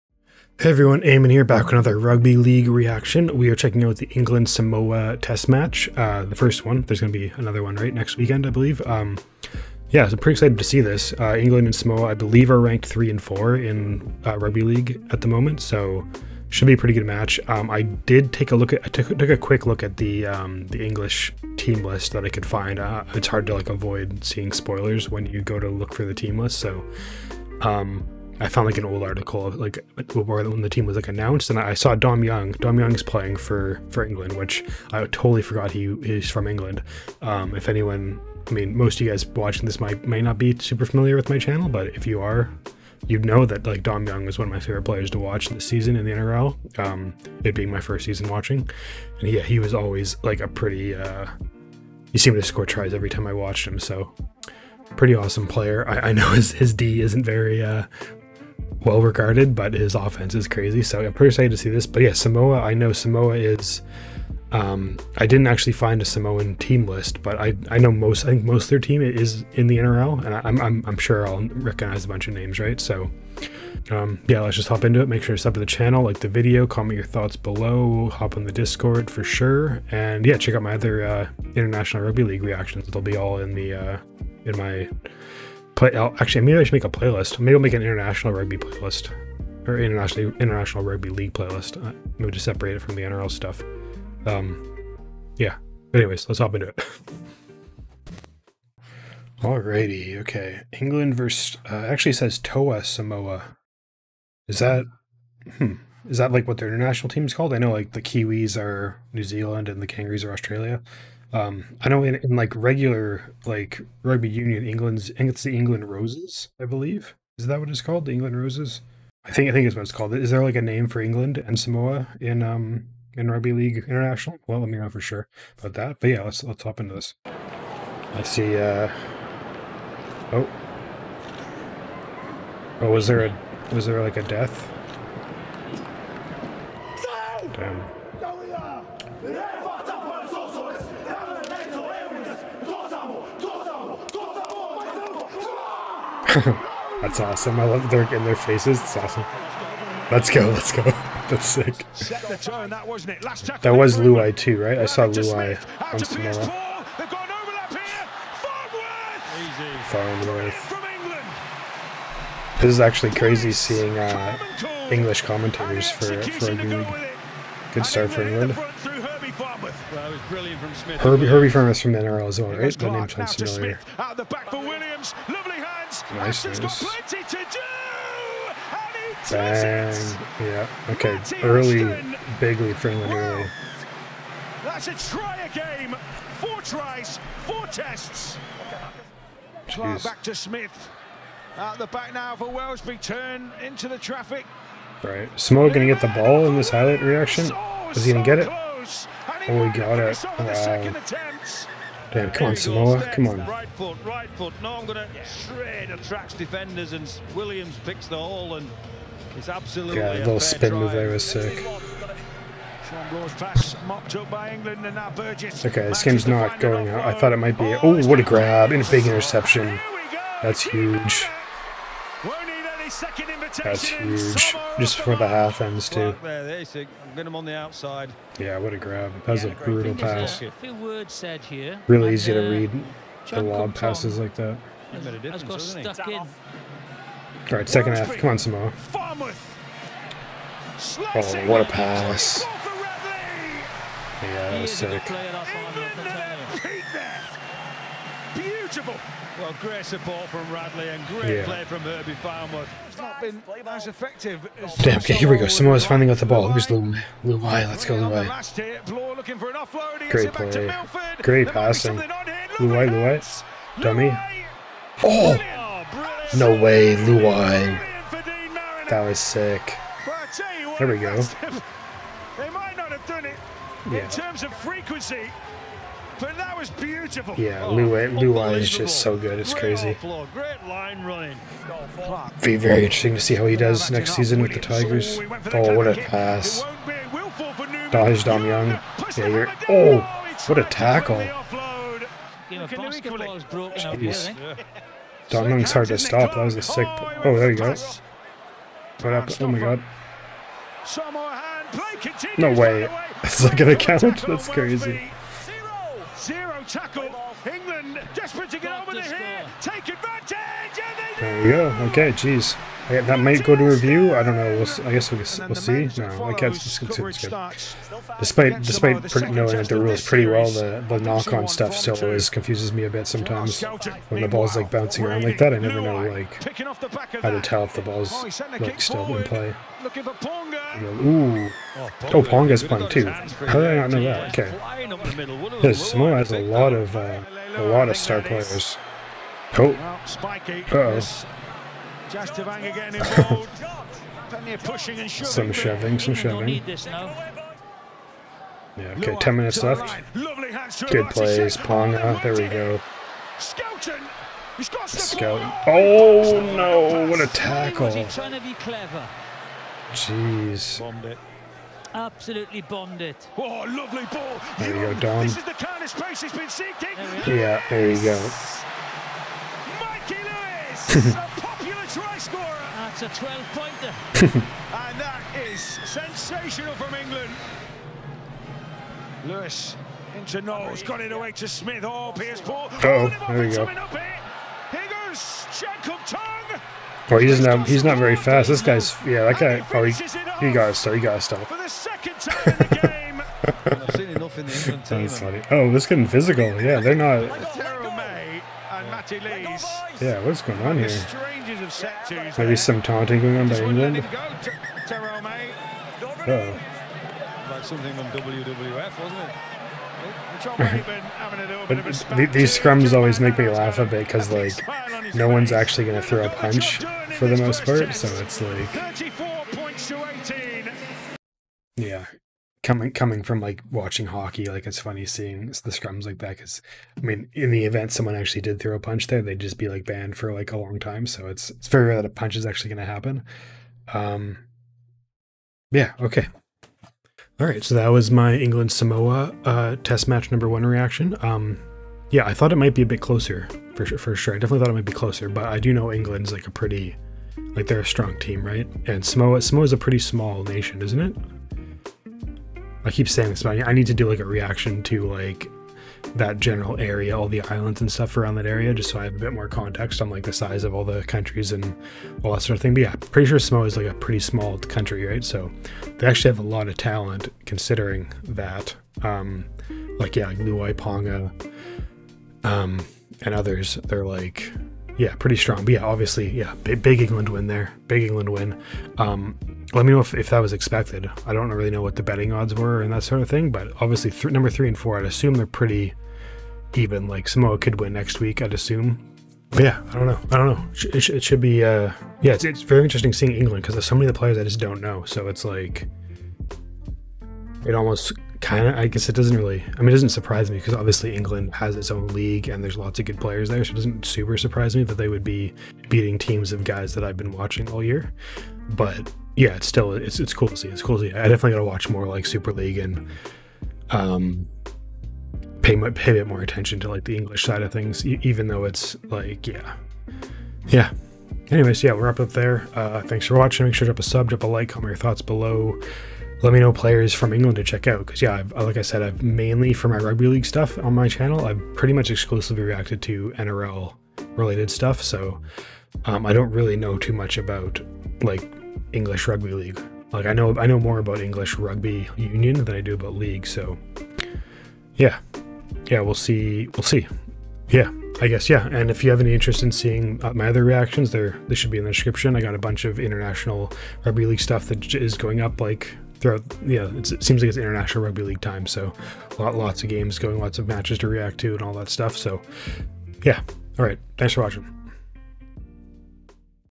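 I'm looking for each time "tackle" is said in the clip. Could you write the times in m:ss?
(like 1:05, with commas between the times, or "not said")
4:50, 5:06, 5:57.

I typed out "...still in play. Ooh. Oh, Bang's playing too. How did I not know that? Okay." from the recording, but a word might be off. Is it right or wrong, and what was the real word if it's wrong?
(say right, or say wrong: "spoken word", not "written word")
wrong: "Ponga", not "Bang".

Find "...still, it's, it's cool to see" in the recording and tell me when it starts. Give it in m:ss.
8:29.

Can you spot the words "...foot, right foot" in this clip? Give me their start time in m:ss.
3:23.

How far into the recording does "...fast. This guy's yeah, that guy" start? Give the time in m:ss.
6:28.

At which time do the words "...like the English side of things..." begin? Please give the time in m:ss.
8:36.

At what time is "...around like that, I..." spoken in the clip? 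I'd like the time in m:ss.
5:25.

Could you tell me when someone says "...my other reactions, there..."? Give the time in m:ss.
9:10.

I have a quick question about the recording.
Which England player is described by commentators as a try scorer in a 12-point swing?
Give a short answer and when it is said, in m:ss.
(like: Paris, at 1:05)
Mikey Lewis, at 6:09.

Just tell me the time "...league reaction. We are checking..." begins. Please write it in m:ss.
0:02.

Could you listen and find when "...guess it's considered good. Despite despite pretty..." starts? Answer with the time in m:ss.
5:16.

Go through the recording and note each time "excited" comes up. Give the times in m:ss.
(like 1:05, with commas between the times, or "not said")
0:10, 1:01.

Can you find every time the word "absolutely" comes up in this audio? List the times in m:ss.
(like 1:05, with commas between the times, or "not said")
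3:29, 6:01.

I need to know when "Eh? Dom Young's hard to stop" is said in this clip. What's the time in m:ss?
4:54.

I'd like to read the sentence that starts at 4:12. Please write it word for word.
It's not been as effective as Damn, okay, here we go.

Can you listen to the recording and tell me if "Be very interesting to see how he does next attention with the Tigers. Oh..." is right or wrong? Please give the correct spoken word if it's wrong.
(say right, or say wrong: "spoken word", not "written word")
wrong: "season", not "attention".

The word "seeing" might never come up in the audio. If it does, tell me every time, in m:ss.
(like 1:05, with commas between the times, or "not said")
0:24, 2:43, 7:05, 8:13, 9:09.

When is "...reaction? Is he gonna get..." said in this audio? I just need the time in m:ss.
3:17.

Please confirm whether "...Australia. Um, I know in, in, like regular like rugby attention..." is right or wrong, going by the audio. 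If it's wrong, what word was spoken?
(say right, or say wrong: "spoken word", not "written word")
wrong: "union", not "attention".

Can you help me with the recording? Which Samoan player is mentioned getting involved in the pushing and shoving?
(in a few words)
Jazz Tevaga.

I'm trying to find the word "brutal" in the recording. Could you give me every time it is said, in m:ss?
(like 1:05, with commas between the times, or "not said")
3:49.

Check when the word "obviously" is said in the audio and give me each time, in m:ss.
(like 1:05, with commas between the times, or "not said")
7:55, 8:03, 8:20.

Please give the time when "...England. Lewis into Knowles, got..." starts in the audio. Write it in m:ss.
6:16.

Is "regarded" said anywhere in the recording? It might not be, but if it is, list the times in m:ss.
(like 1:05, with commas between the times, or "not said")
0:59.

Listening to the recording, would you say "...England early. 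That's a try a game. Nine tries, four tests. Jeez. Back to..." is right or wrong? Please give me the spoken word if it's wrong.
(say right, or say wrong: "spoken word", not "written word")
wrong: "Four", not "Nine".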